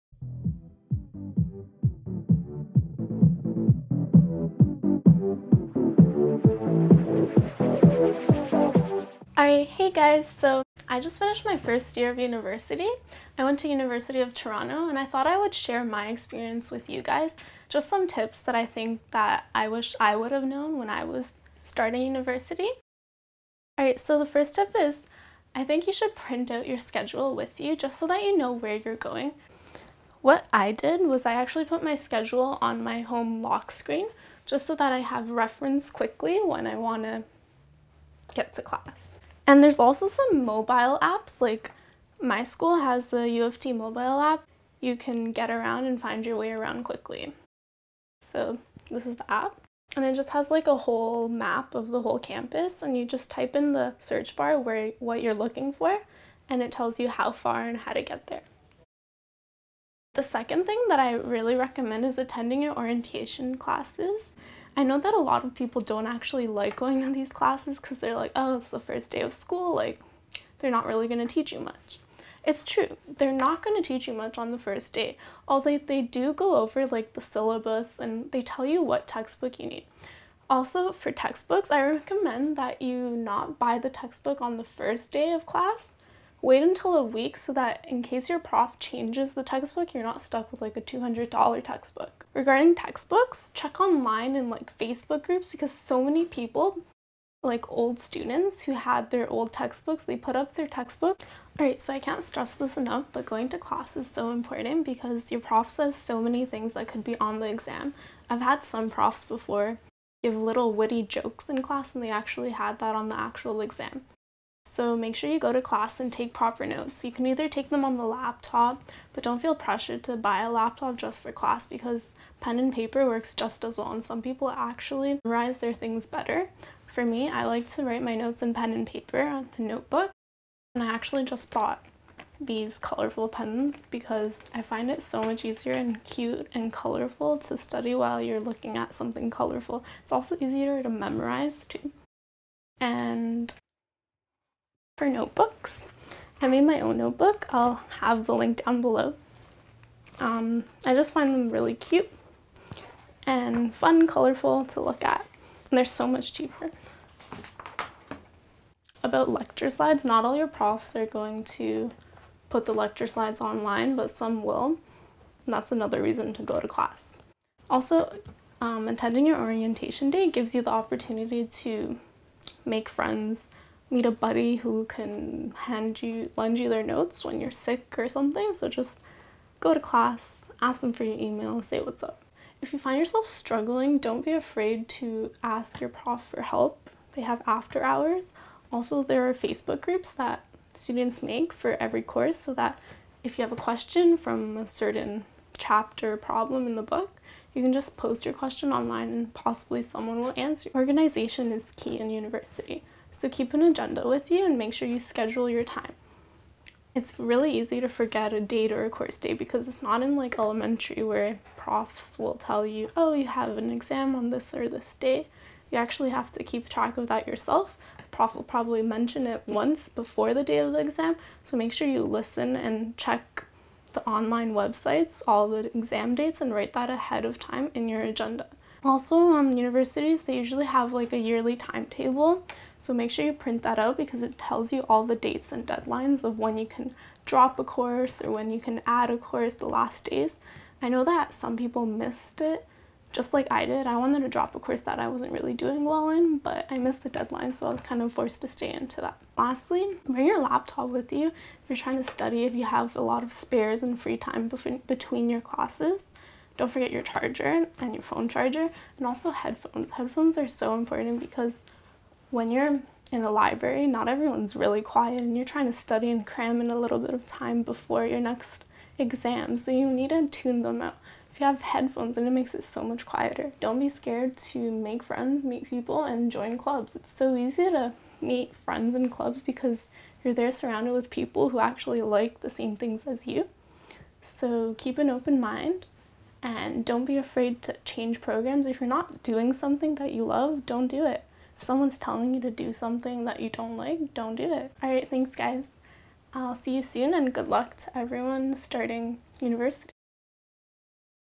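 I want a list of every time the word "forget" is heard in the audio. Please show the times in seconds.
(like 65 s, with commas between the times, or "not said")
207 s, 256 s.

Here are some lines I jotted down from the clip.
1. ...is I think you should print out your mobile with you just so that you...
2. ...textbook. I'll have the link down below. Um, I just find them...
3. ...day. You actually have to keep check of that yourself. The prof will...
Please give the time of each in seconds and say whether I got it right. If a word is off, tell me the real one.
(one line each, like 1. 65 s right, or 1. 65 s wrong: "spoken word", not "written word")
1. 24 s wrong: "schedule", not "mobile"
2. 146 s wrong: "notebook", not "textbook"
3. 214 s wrong: "track", not "check".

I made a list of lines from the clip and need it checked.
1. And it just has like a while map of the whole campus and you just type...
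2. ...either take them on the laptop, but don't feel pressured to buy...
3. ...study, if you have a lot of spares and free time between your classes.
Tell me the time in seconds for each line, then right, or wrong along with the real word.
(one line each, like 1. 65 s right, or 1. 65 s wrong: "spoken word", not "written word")
1. 49 s wrong: "whole", not "while"
2. 117 s right
3. 252 s right.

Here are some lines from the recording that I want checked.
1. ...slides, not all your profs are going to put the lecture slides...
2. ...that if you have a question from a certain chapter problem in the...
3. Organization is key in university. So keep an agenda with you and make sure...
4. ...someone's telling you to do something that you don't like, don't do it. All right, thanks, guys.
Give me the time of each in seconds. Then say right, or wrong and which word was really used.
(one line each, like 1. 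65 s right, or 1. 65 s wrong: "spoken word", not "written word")
1. 159 s right
2. 192 s right
3. 200 s right
4. 291 s right.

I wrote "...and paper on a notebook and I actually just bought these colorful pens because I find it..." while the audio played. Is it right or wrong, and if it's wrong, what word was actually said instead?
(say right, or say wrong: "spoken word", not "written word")
right.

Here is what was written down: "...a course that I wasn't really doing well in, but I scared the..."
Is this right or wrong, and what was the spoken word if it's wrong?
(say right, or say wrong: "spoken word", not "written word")
wrong: "missed", not "scared".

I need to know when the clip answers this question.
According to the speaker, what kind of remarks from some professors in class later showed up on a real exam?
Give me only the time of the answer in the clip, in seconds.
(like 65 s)
110 s.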